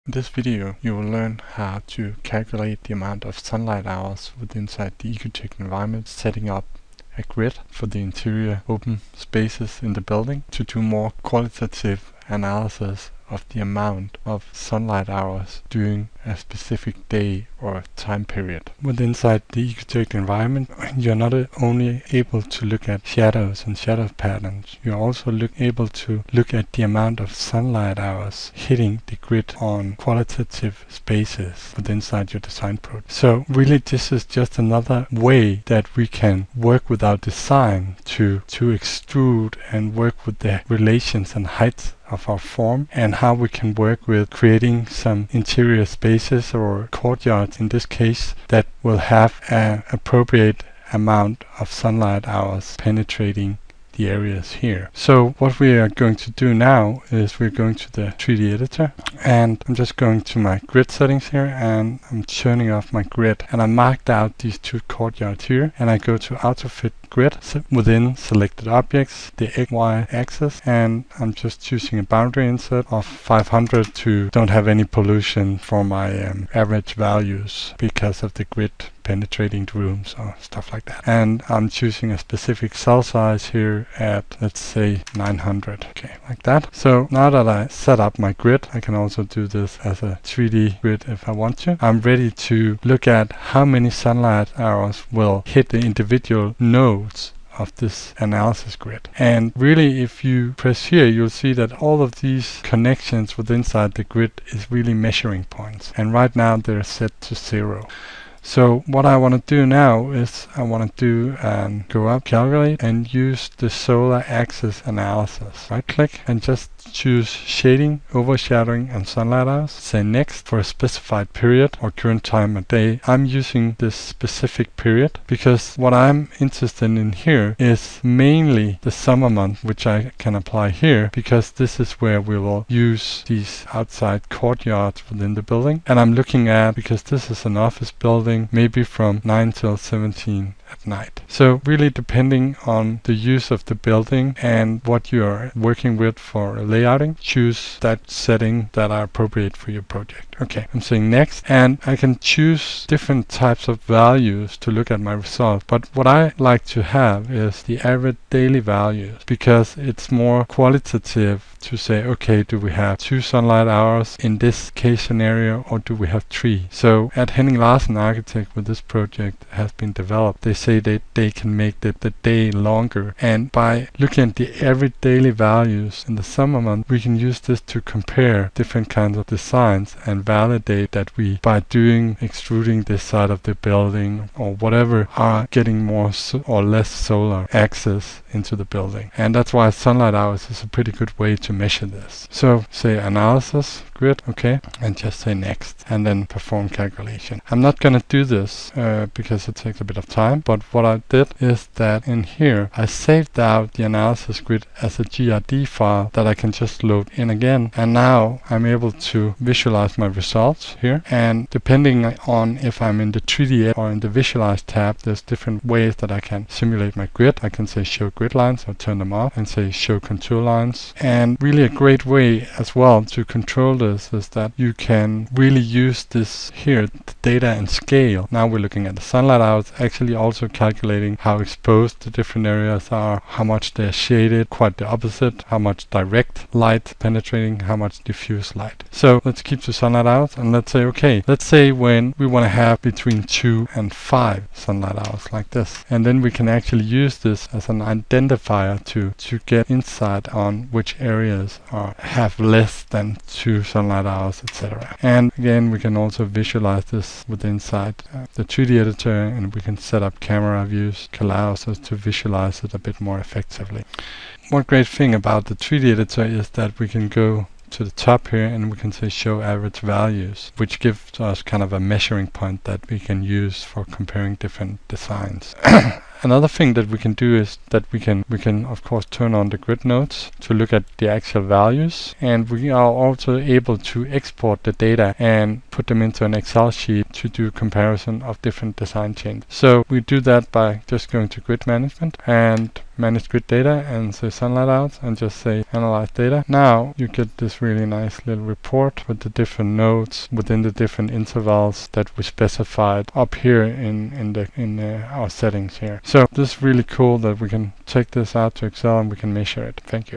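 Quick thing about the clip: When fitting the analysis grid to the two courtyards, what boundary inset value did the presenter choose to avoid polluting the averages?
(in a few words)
500.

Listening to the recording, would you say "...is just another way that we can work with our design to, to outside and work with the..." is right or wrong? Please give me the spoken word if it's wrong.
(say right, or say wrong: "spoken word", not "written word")
wrong: "extrude", not "outside".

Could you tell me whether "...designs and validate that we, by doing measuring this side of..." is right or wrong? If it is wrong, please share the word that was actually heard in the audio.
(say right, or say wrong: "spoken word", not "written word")
wrong: "extruding", not "measuring".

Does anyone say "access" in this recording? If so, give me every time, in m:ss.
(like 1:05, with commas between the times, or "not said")
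1:54, 3:07.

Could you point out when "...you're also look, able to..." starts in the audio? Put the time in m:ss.
0:24.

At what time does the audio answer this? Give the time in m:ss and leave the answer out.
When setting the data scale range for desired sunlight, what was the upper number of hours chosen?
4:03.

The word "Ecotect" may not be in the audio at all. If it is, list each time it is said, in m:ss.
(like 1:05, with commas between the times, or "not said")
0:05, 0:19.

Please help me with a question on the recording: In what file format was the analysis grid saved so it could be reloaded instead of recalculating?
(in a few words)
GRD.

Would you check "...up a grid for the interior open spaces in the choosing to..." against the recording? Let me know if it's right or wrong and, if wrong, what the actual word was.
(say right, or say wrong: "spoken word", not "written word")
wrong: "building", not "choosing".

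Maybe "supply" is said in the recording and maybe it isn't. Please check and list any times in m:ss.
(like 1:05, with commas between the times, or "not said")
not said.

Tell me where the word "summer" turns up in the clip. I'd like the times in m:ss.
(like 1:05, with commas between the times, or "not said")
2:08, 2:56.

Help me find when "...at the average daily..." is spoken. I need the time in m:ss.
2:54.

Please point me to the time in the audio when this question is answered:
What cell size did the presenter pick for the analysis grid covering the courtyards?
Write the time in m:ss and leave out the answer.
1:25.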